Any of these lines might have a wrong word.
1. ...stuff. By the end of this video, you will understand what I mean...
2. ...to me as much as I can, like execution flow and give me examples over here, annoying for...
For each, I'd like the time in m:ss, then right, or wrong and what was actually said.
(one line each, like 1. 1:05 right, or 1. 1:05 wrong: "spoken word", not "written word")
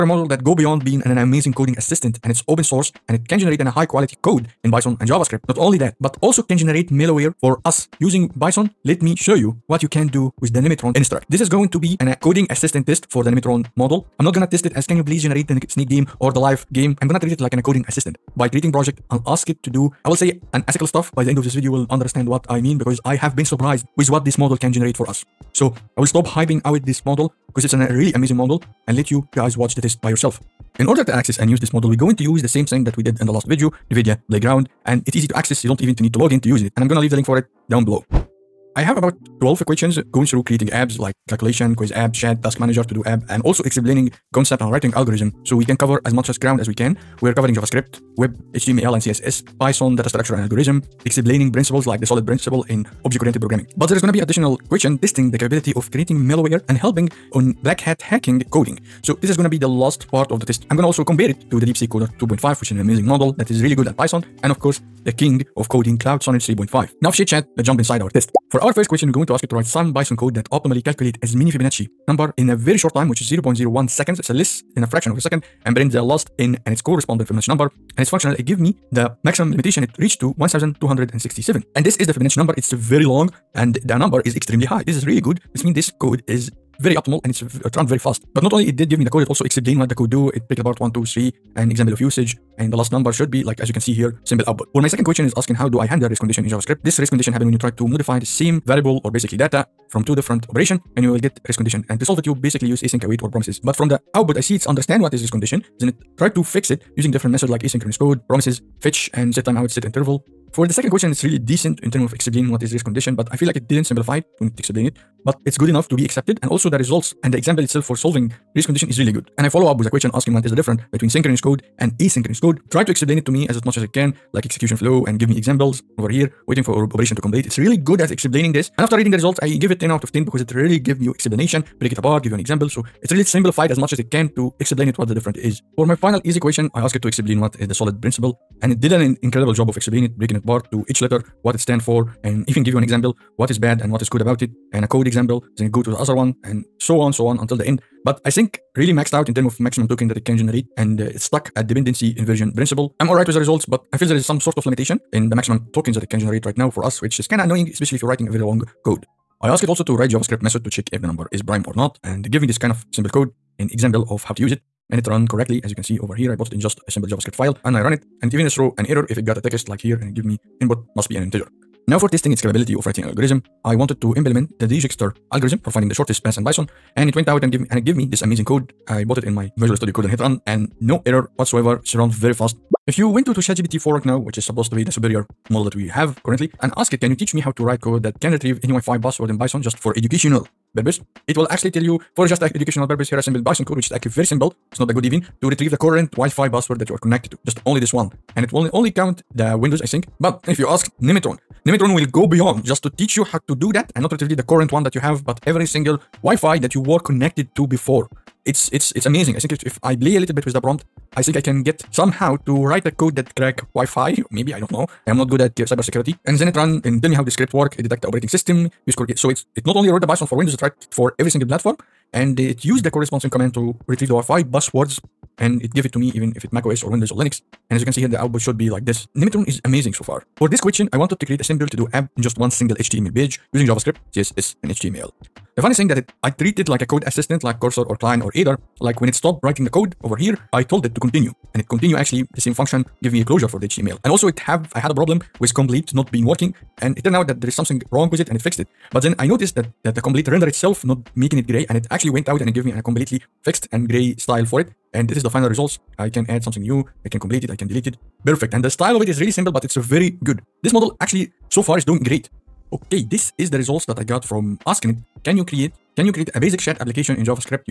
1. 0:20 right
2. 2:03 wrong: "waiting", not "annoying".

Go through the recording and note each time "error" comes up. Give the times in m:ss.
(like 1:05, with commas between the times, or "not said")
2:48, 3:01.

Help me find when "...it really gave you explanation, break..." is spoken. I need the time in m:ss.
2:10.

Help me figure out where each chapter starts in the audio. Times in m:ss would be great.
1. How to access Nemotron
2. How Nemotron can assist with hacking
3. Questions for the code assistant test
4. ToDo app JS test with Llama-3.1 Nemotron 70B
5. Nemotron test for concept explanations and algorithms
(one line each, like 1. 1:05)
1. 0:30
2. 3:03
3. 0:37
4. 3:50
5. 1:07.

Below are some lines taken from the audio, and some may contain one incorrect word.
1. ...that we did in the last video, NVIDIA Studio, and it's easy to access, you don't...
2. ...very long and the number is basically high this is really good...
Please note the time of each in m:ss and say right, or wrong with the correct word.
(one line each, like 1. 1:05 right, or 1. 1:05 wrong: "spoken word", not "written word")
1. 0:32 wrong: "Playground", not "Studio"
2. 1:22 wrong: "extremely", not "basically".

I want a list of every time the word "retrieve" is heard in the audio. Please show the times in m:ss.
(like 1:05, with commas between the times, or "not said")
3:08, 3:15, 3:24, 3:43.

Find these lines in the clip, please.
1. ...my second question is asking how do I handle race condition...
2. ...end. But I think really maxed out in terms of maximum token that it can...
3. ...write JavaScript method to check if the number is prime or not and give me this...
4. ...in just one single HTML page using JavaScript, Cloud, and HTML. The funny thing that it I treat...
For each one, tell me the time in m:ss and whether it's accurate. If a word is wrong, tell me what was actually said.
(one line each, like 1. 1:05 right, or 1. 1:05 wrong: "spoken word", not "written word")
1. 1:34 right
2. 2:27 right
3. 2:39 right
4. 3:52 wrong: "CSS", not "Cloud".